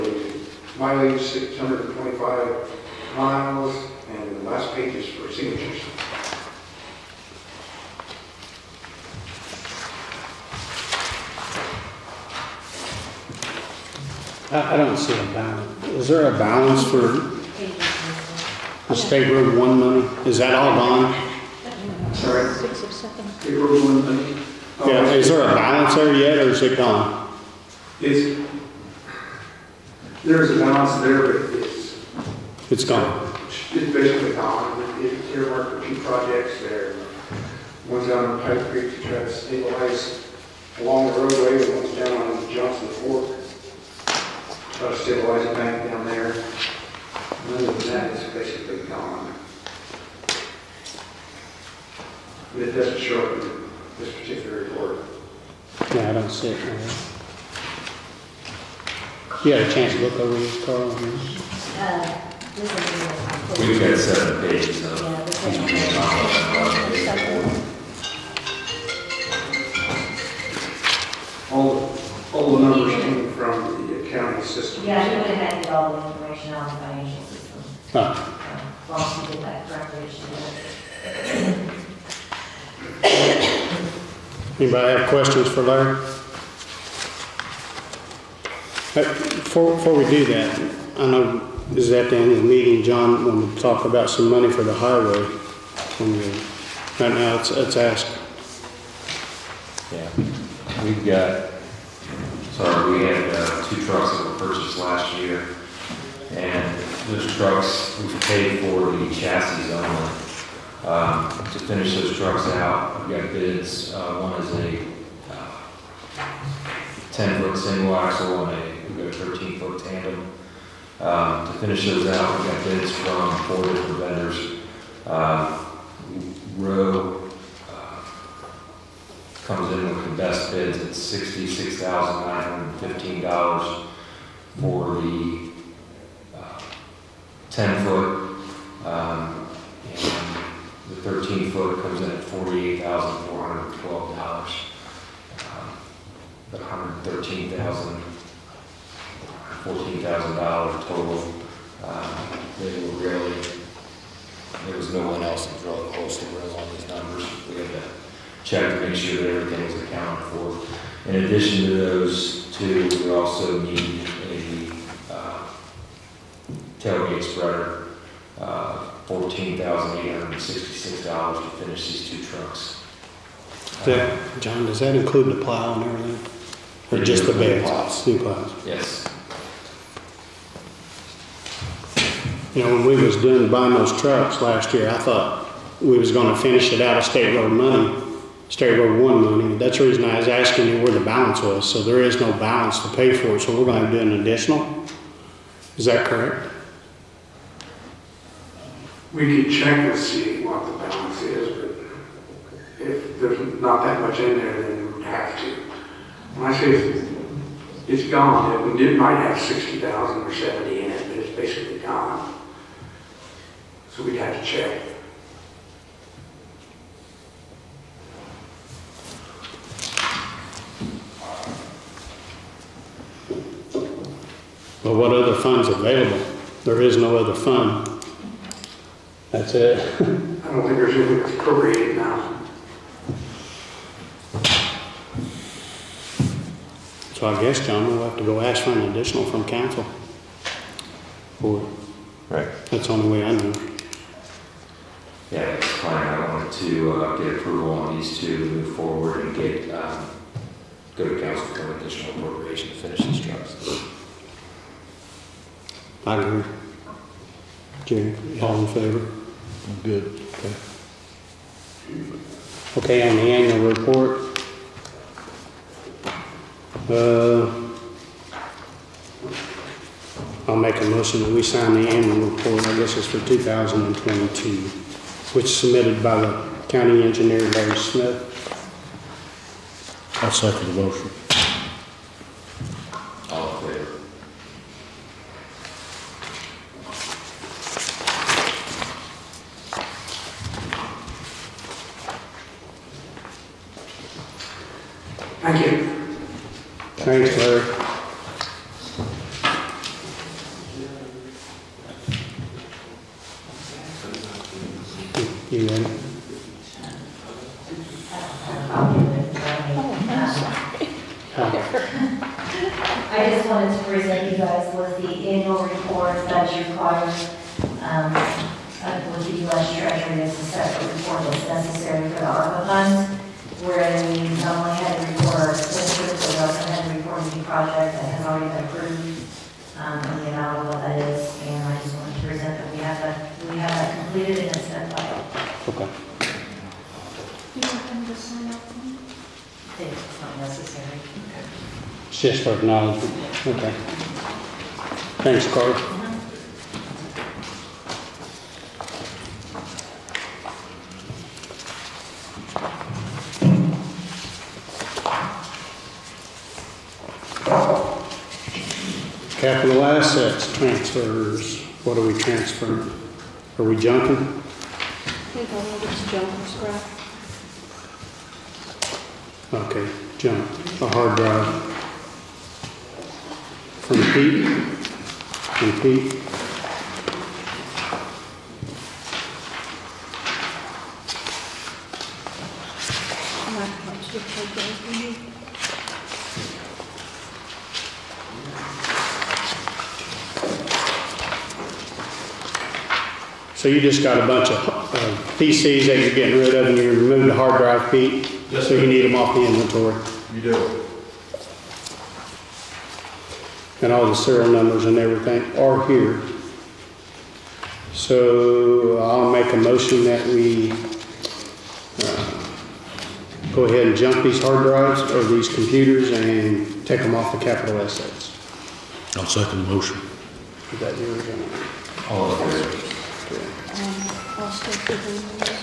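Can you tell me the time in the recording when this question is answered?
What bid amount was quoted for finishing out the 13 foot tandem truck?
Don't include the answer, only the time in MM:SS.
02:22.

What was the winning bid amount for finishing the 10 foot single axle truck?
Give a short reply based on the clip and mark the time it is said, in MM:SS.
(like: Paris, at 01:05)
$66,915, at 02:10.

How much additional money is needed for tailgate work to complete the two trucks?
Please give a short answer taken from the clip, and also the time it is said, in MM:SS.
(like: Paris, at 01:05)
$14,866, at 02:49.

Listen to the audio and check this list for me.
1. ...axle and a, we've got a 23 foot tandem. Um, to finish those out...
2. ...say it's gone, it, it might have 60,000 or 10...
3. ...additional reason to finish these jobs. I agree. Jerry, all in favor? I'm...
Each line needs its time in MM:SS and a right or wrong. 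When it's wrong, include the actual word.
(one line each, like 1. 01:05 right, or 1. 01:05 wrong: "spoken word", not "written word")
1. 01:57 wrong: "13", not "23"
2. 03:26 wrong: "70", not "10"
3. 04:11 wrong: "appropriation", not "reason".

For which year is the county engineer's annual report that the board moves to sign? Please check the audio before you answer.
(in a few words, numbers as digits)
2022.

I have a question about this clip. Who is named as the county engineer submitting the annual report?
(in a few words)
Larry Smith.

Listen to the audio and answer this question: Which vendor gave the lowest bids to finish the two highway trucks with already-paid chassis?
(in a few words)
Rowe.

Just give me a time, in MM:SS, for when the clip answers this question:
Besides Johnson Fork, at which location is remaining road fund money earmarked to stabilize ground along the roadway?
00:38.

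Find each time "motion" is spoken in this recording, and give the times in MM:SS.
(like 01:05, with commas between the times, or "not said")
04:30, 04:40, 06:49, 06:59.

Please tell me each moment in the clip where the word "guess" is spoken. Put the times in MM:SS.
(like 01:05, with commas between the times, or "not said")
03:57, 04:32.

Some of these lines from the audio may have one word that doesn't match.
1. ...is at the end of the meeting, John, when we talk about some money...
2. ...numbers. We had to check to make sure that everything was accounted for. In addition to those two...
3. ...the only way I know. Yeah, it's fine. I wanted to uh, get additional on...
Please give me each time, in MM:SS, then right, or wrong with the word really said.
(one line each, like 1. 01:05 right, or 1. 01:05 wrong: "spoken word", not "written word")
1. 01:31 right
2. 02:36 right
3. 04:02 wrong: "approval", not "additional".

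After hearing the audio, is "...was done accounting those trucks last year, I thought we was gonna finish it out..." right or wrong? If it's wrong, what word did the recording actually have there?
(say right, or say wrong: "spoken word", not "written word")
wrong: "buying", not "accounting".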